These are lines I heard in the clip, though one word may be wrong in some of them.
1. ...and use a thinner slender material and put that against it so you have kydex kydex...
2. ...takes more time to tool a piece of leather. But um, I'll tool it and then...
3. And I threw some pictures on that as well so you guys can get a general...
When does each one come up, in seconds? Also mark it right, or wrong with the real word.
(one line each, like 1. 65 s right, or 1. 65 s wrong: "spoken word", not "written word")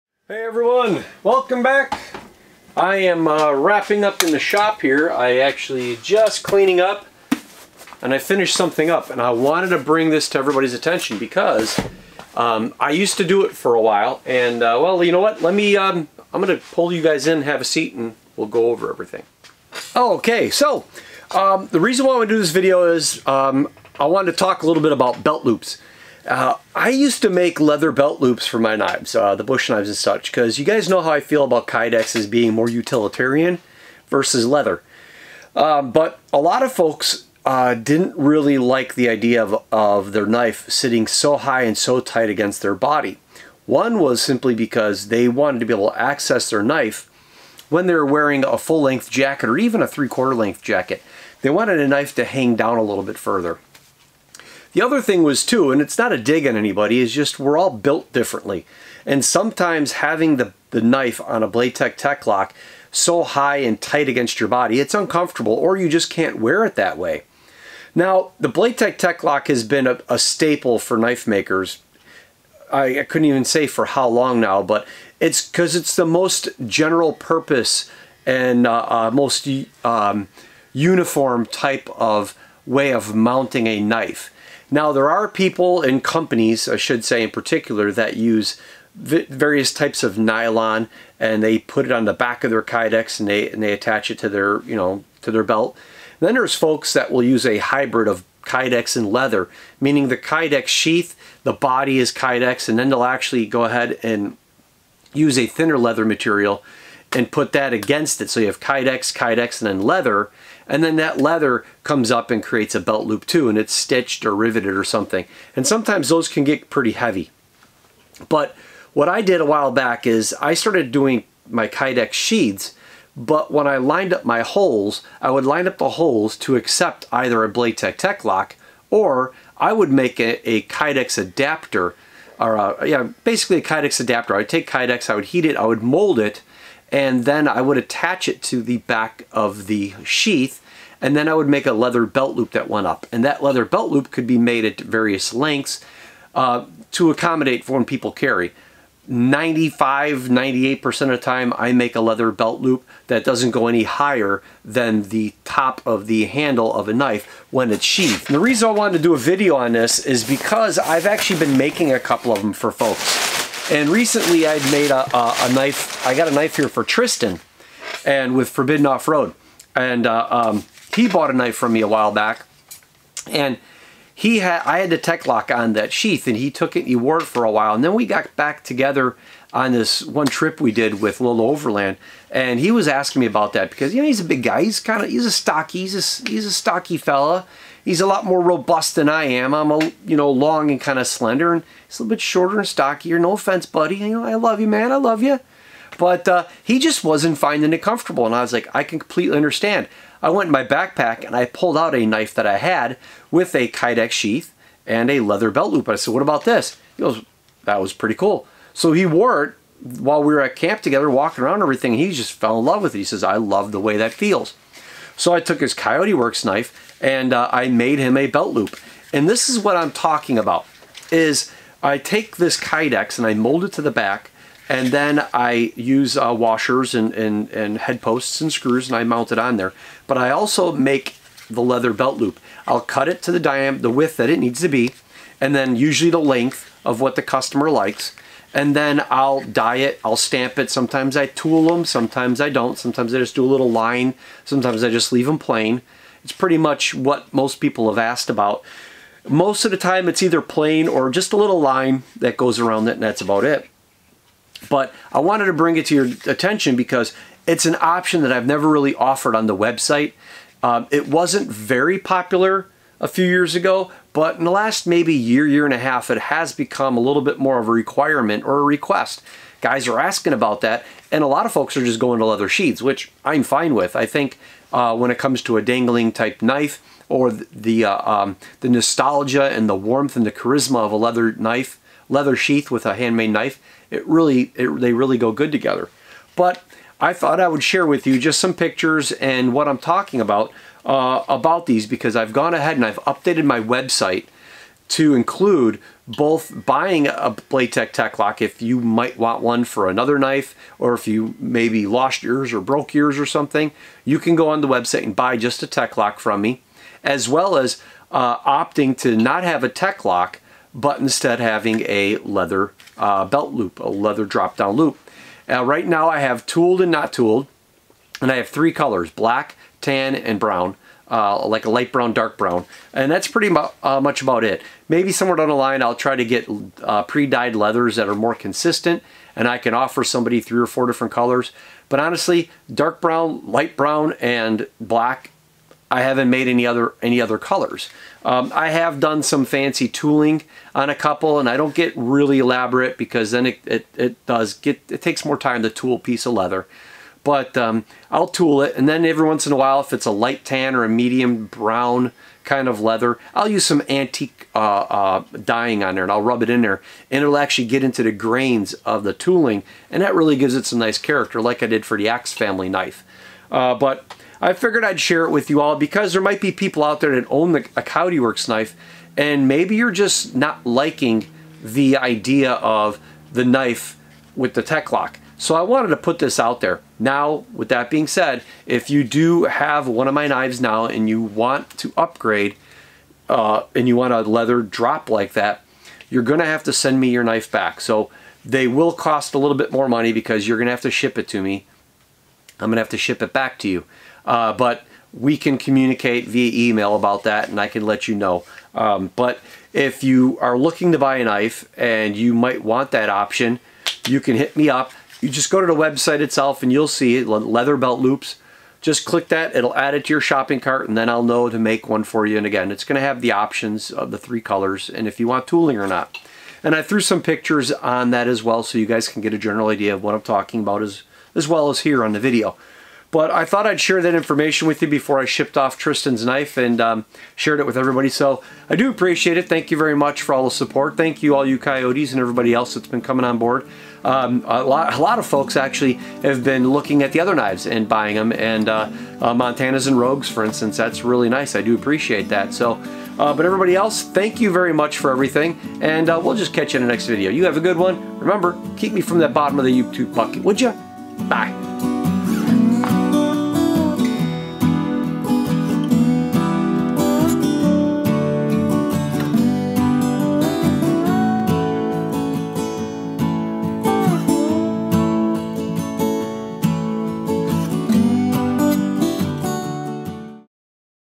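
1. 104 s wrong: "leather", not "slender"
2. 345 s right
3. 416 s right.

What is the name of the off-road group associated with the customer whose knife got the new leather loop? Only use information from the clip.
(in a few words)
Forbidden Off-Road.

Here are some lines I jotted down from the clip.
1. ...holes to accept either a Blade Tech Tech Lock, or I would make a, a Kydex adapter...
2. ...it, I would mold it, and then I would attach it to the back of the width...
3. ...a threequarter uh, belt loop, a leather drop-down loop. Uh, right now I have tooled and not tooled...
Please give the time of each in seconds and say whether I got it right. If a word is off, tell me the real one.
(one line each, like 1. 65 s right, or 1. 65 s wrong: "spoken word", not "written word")
1. 125 s right
2. 135 s wrong: "sheath", not "width"
3. 311 s wrong: "leather", not "threequarter".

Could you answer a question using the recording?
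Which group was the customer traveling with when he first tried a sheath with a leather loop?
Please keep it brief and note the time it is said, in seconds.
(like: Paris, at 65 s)
Lil Overland, at 181 s.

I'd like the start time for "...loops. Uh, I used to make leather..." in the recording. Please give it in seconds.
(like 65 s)
25 s.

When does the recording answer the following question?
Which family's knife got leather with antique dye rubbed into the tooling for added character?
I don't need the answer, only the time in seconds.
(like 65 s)
362 s.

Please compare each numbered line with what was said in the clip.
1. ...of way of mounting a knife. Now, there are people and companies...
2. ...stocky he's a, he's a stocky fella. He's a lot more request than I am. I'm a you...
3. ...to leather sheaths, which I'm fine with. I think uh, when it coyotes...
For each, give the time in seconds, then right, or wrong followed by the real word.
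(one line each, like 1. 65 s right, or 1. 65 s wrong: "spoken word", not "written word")
1. 81 s right
2. 185 s wrong: "robust", not "request"
3. 272 s wrong: "comes", not "coyotes".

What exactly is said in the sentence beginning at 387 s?
So they will cost a little bit more money because you're gonna have to ship it to me.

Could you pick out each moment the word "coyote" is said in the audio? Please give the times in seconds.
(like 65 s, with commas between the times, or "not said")
215 s, 367 s, 431 s.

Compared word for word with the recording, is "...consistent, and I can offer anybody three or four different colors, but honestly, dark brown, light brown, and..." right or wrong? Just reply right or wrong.
wrong.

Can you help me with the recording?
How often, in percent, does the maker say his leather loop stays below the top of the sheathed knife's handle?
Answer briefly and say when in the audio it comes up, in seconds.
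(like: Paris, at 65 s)
95, 98%, at 149 s.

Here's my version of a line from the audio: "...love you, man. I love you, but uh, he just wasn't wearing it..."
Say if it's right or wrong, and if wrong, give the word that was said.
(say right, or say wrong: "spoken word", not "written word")
wrong: "finding", not "wearing".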